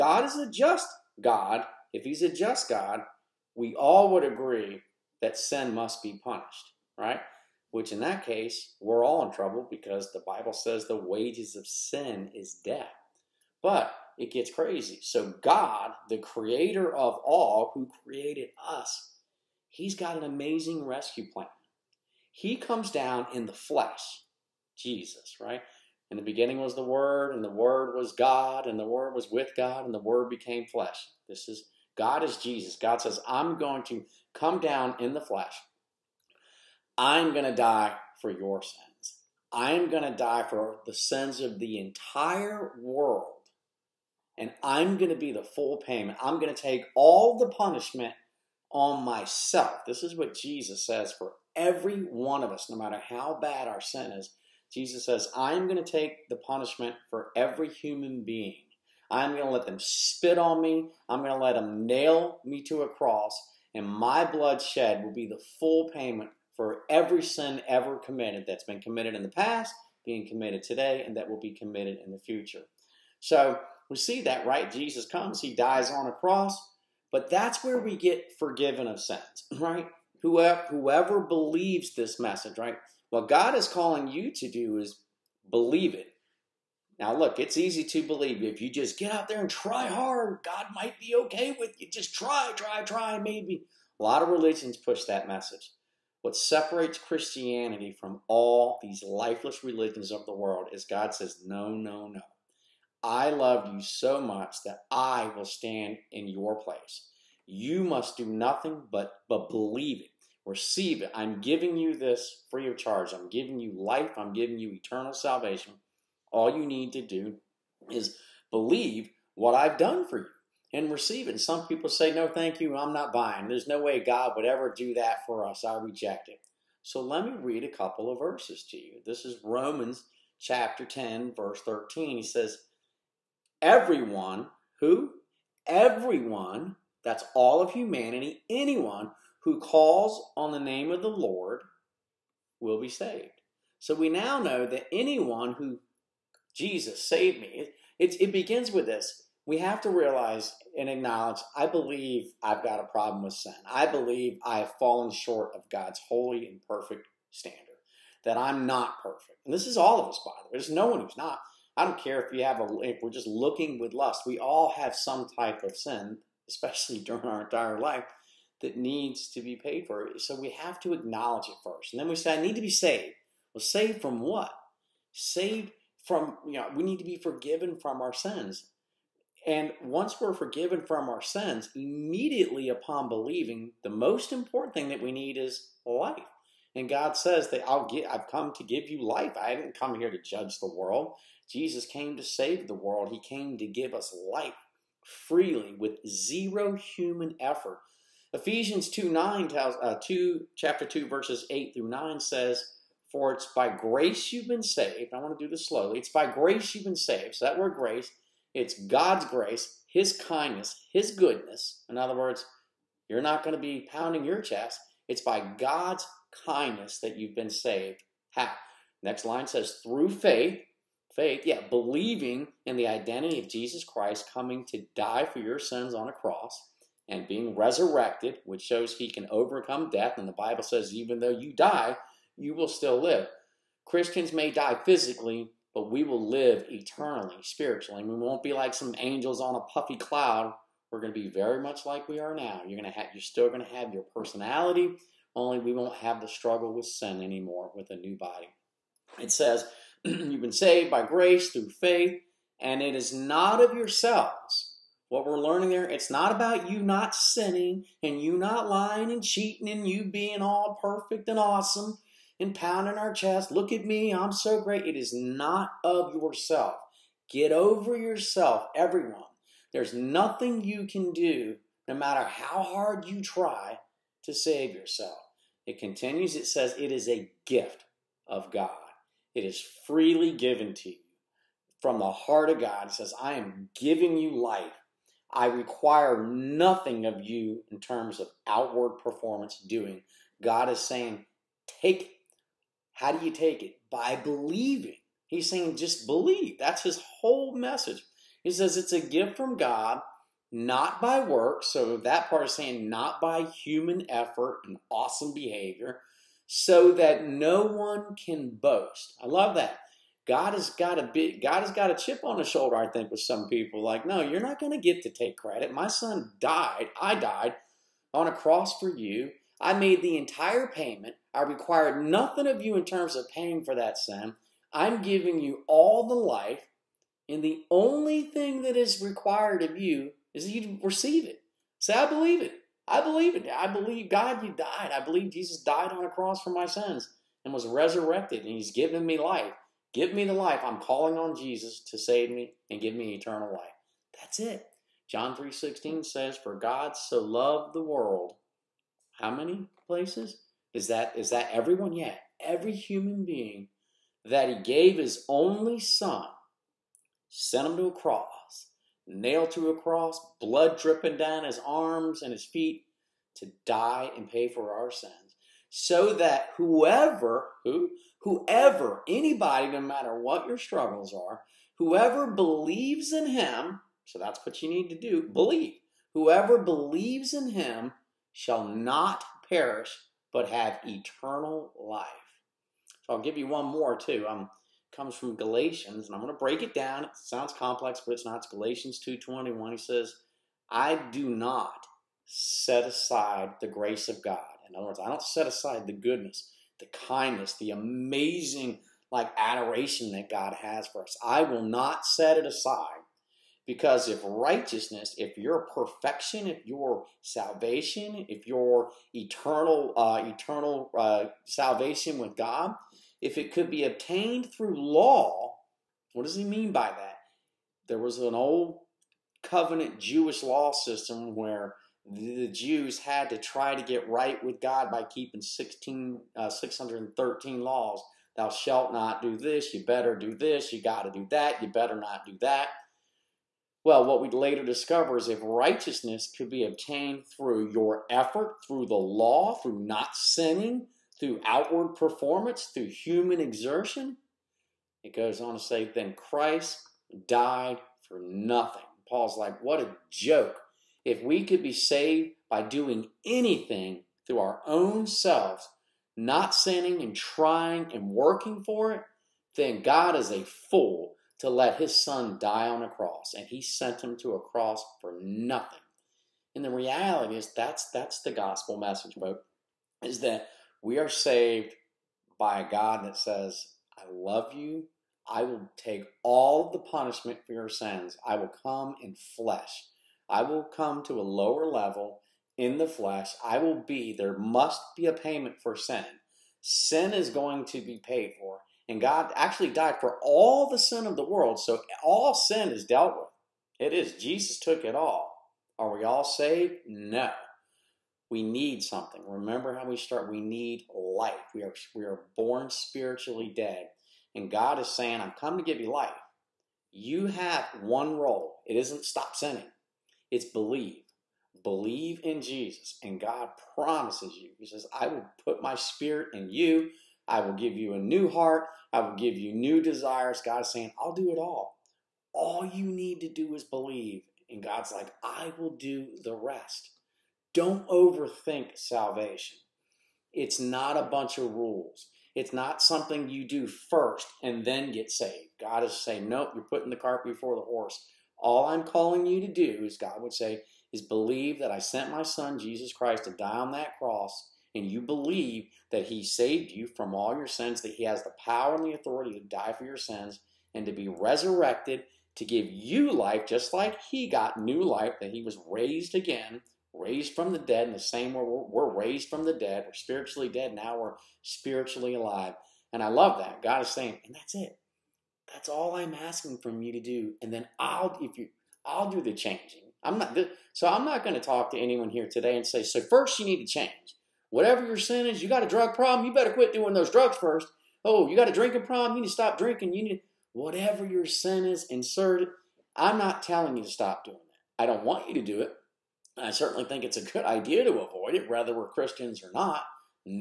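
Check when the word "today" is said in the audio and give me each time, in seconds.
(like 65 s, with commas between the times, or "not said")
70 s, 572 s.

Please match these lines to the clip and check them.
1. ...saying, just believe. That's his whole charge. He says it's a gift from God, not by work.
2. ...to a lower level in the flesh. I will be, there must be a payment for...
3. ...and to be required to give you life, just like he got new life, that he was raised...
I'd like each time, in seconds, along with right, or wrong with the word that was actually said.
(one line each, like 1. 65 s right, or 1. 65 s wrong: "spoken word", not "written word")
1. 295 s wrong: "message", not "charge"
2. 481 s right
3. 550 s wrong: "resurrected", not "required".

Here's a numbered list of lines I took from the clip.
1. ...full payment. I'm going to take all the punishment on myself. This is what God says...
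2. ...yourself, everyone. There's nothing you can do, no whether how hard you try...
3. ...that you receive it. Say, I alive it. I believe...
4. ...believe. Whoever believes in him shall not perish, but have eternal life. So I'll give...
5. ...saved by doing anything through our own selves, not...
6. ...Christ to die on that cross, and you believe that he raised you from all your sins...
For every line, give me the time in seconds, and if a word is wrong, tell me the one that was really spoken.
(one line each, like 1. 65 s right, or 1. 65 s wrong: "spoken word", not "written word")
1. 45 s wrong: "Jesus", not "God"
2. 267 s wrong: "matter", not "whether"
3. 330 s wrong: "believe", not "alive"
4. 375 s right
5. 451 s right
6. 542 s wrong: "saved", not "raised".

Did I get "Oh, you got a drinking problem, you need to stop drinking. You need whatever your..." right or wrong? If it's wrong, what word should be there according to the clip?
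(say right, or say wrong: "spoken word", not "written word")
right.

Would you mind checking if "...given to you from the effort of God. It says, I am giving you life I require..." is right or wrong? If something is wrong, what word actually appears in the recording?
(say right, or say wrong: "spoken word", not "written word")
wrong: "heart", not "effort".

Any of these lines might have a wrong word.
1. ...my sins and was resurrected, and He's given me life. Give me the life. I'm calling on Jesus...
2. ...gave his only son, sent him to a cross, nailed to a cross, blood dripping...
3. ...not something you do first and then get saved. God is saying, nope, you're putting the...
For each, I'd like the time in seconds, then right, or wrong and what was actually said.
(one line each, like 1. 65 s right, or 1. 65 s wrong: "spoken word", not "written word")
1. 336 s right
2. 354 s right
3. 532 s right.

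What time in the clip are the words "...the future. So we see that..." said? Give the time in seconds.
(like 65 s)
72 s.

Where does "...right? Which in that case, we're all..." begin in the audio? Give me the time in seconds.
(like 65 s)
6 s.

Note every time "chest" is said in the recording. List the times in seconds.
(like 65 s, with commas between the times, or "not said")
214 s, 263 s.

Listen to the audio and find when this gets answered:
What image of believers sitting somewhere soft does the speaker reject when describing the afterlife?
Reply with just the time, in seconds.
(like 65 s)
238 s.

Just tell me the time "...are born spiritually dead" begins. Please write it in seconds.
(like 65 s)
502 s.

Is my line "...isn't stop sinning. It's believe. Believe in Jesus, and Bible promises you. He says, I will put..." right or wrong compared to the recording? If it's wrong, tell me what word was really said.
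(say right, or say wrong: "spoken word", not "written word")
wrong: "God", not "Bible".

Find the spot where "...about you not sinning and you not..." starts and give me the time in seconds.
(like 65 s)
256 s.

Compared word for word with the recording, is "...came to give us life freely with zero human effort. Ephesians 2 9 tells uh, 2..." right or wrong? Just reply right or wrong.
right.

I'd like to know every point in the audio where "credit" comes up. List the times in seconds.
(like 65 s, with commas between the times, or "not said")
315 s.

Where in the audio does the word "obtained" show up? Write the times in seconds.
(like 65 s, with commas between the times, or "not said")
413 s, 436 s.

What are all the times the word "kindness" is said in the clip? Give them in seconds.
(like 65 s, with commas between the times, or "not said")
210 s, 216 s, 397 s.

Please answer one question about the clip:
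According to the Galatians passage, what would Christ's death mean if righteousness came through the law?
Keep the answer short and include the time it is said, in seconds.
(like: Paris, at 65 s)
Christ died for nothing, at 445 s.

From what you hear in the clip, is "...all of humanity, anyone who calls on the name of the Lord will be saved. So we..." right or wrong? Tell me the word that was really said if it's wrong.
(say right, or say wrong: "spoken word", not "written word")
right.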